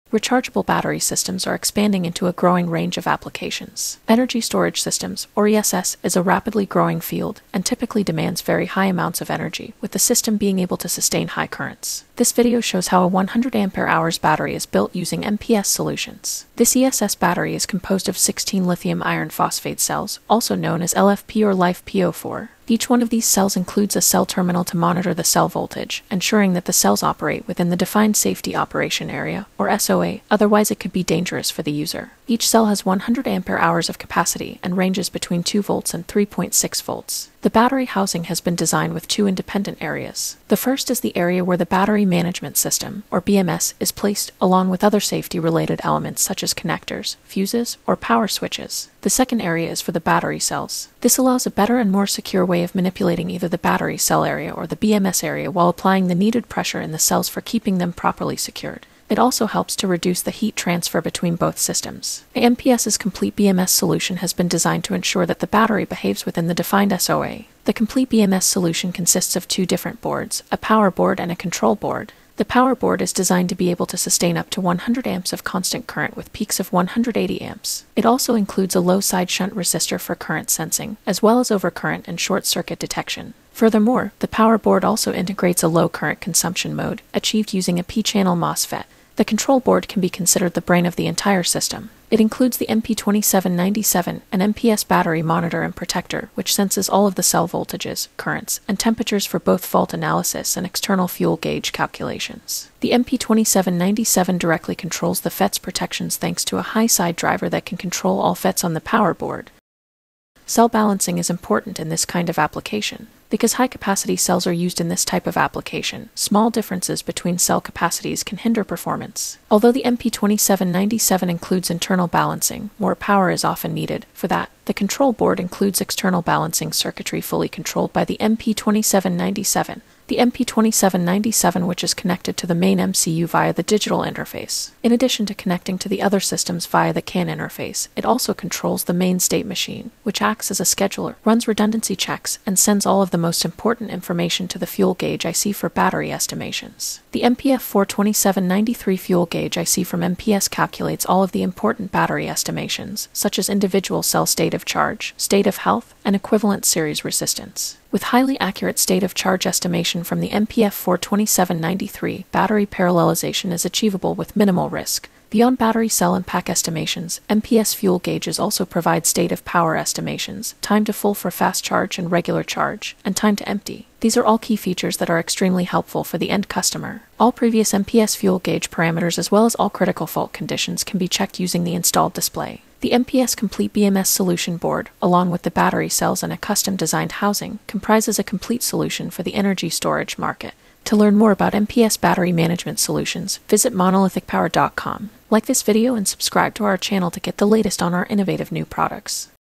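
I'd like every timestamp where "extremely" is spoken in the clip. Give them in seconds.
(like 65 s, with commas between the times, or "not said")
175 s.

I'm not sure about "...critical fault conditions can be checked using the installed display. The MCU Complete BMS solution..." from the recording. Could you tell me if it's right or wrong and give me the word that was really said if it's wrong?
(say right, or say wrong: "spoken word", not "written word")
wrong: "MPS", not "MCU".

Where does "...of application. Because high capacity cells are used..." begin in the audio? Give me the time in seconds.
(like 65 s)
112 s.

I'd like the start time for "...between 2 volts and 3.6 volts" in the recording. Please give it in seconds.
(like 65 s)
35 s.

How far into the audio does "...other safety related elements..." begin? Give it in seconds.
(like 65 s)
44 s.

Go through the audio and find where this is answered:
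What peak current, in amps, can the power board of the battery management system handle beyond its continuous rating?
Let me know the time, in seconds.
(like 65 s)
76 s.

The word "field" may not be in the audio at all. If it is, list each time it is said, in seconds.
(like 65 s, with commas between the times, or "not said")
7 s.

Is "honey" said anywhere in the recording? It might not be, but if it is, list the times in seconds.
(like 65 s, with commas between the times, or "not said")
not said.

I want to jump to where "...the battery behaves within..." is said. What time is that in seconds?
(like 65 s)
65 s.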